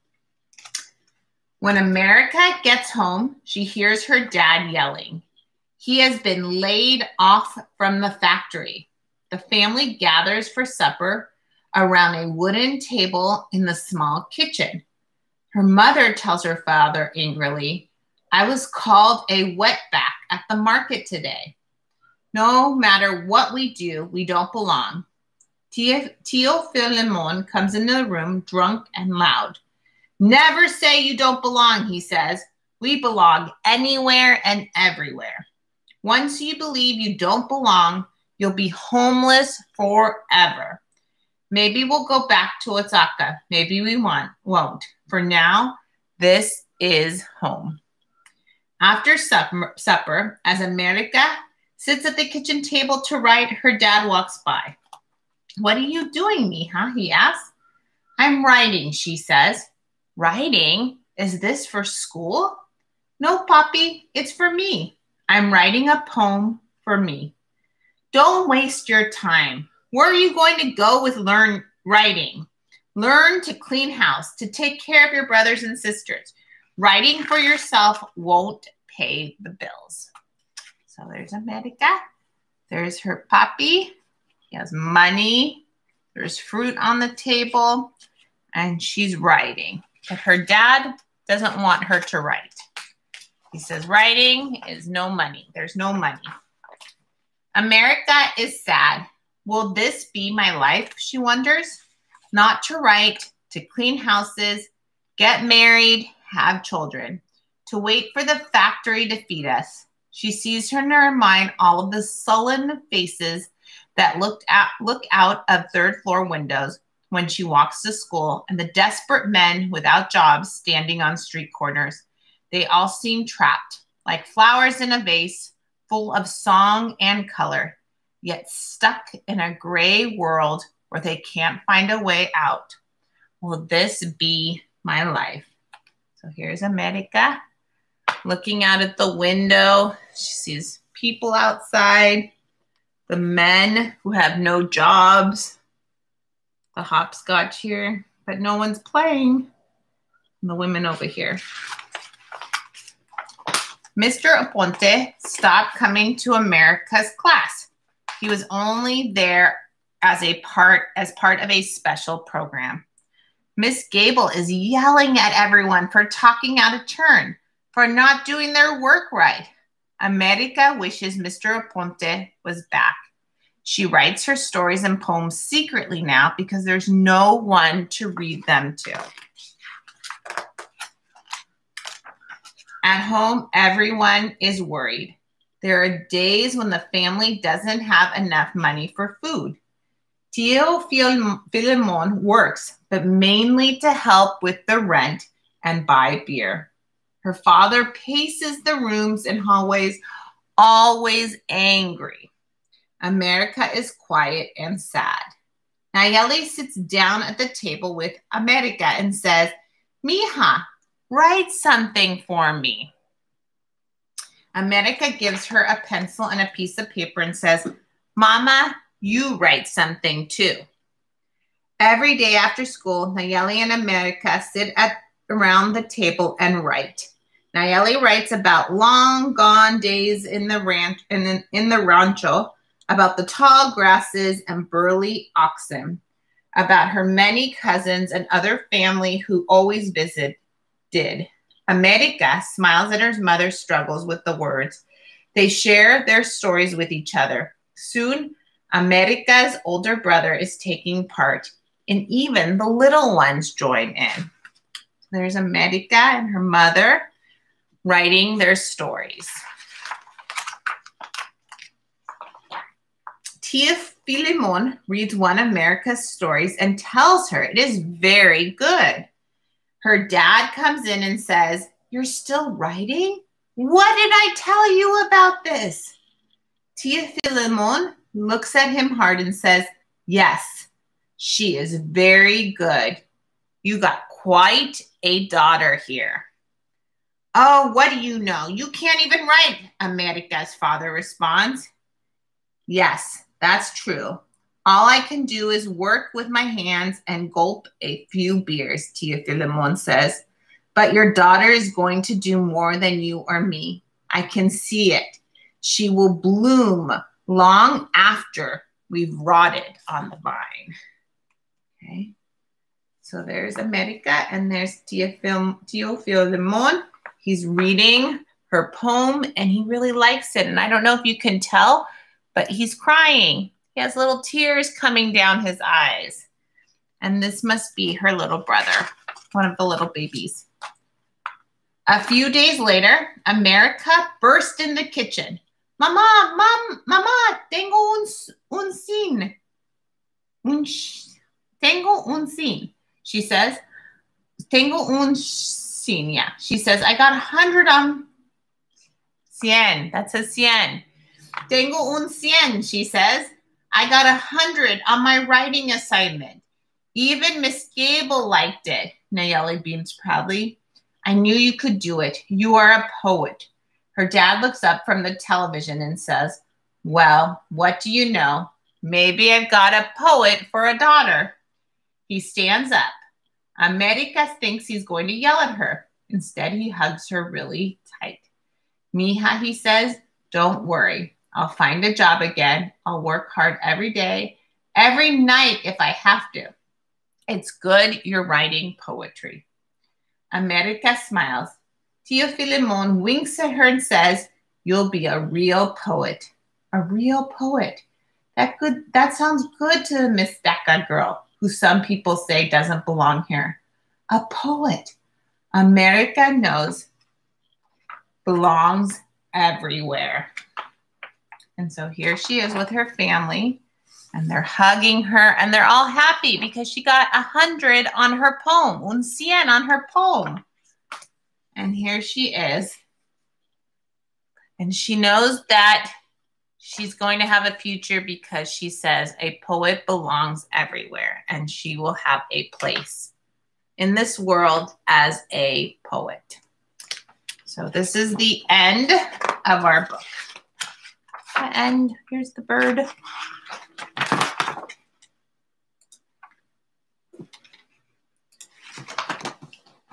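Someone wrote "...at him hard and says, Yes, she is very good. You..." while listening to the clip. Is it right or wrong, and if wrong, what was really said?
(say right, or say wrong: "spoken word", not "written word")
right.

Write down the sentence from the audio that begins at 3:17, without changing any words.
Her father paces the rooms and hallways, always angry.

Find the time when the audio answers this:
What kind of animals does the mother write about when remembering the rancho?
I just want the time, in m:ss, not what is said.
3:55.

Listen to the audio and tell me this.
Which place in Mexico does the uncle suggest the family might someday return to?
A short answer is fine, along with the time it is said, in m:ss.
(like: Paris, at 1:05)
Oaxaca, at 0:42.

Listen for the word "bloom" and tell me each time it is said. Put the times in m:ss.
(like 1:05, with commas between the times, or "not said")
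5:06.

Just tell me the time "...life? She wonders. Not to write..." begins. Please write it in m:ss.
1:40.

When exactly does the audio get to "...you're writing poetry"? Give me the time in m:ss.
6:28.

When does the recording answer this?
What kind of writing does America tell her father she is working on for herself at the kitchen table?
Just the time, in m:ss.
1:05.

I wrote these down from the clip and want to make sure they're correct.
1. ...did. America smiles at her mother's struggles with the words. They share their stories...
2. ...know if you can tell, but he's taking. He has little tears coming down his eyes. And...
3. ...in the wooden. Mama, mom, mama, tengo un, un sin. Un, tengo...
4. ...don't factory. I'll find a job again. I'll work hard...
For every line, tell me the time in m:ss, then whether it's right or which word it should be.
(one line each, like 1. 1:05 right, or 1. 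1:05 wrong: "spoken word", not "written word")
1. 4:00 right
2. 5:20 wrong: "crying", not "taking"
3. 5:34 wrong: "kitchen", not "wooden"
4. 6:20 wrong: "worry", not "factory".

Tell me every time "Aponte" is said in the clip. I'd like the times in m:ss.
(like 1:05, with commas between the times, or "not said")
2:34, 2:51.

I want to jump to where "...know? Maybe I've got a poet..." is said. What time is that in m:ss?
6:08.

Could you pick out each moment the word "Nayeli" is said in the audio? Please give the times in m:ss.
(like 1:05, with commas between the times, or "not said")
3:25, 3:43, 3:47, 5:59.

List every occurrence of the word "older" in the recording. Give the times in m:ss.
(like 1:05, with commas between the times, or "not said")
4:09.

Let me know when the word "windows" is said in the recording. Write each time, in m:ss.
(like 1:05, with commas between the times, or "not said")
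1:56, 2:19.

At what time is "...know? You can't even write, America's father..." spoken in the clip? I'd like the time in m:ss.
4:48.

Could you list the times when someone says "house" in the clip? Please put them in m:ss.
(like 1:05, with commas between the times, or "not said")
1:13, 1:43.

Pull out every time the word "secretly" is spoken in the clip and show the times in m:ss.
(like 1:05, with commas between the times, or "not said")
2:55.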